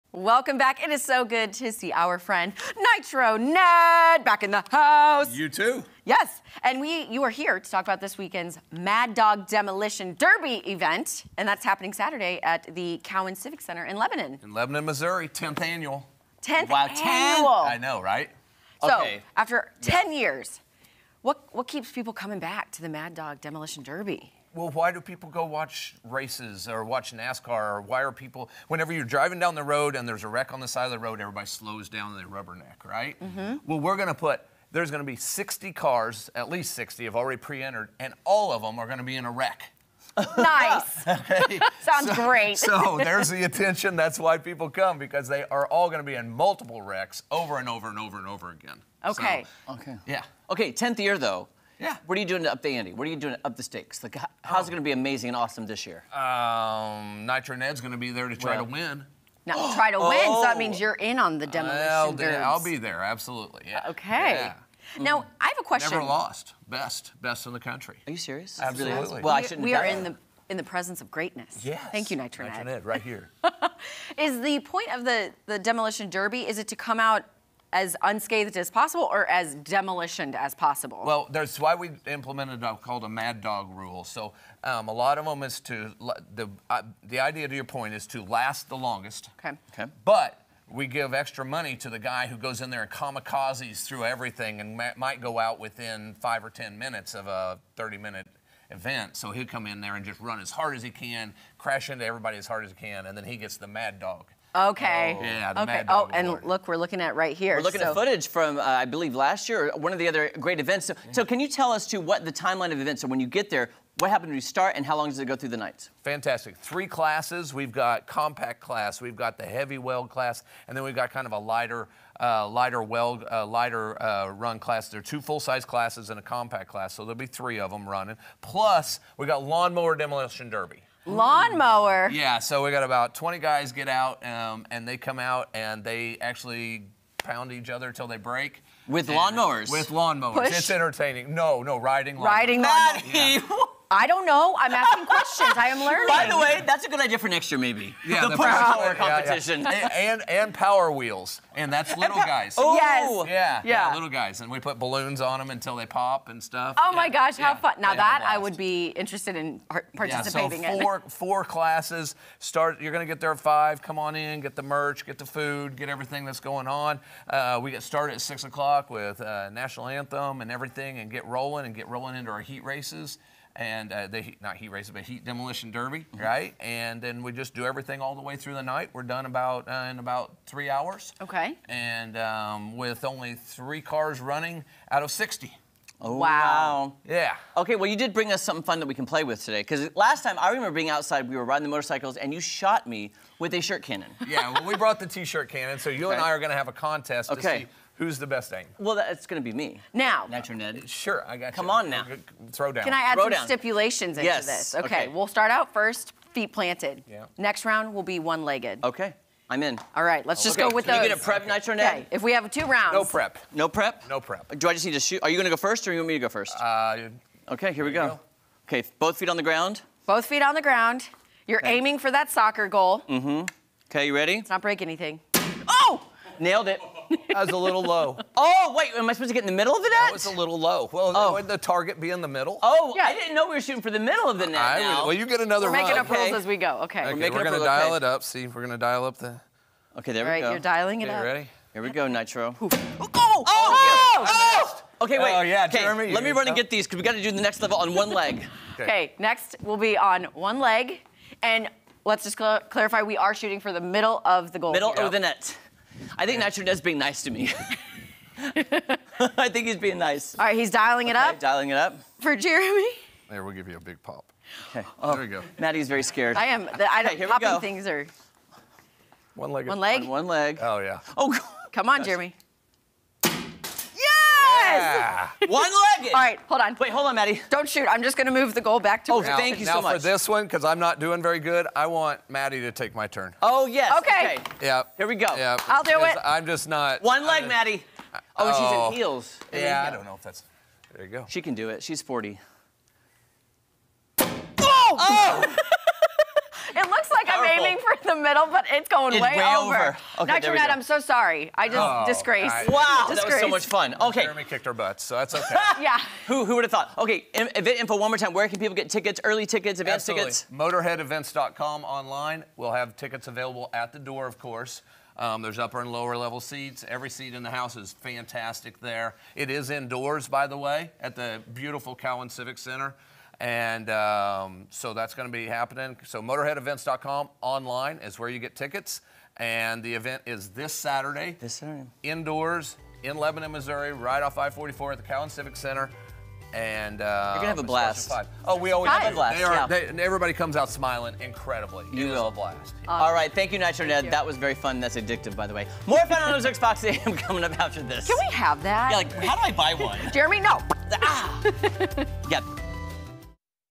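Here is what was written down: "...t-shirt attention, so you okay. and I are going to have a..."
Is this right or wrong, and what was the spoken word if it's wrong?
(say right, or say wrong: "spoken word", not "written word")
wrong: "cannon", not "attention".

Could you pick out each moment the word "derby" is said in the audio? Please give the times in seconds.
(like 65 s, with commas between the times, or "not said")
10 s, 23 s, 76 s, 130 s, 175 s.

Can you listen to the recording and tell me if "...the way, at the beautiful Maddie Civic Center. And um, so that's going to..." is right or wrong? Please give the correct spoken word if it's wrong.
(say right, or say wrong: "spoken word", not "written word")
wrong: "Cowan", not "Maddie".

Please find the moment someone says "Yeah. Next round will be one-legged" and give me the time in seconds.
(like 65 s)
207 s.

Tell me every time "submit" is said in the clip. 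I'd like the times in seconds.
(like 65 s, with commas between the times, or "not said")
not said.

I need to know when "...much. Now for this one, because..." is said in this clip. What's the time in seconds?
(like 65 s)
279 s.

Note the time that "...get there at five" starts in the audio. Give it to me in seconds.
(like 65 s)
163 s.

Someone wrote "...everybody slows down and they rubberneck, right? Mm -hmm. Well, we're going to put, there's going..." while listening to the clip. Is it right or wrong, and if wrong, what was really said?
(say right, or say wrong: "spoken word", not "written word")
right.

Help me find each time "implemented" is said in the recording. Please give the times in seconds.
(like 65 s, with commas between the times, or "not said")
82 s.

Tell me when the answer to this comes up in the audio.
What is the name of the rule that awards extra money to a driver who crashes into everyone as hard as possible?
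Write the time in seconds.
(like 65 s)
83 s.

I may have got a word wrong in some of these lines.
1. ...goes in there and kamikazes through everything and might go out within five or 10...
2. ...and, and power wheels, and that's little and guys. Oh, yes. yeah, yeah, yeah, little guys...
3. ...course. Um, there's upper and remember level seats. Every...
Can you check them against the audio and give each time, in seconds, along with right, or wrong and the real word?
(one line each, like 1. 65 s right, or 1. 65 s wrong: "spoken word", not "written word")
1. 92 s right
2. 150 s right
3. 314 s wrong: "lower", not "remember".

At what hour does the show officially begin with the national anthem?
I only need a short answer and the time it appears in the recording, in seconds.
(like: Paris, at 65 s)
6 o'clock, at 168 s.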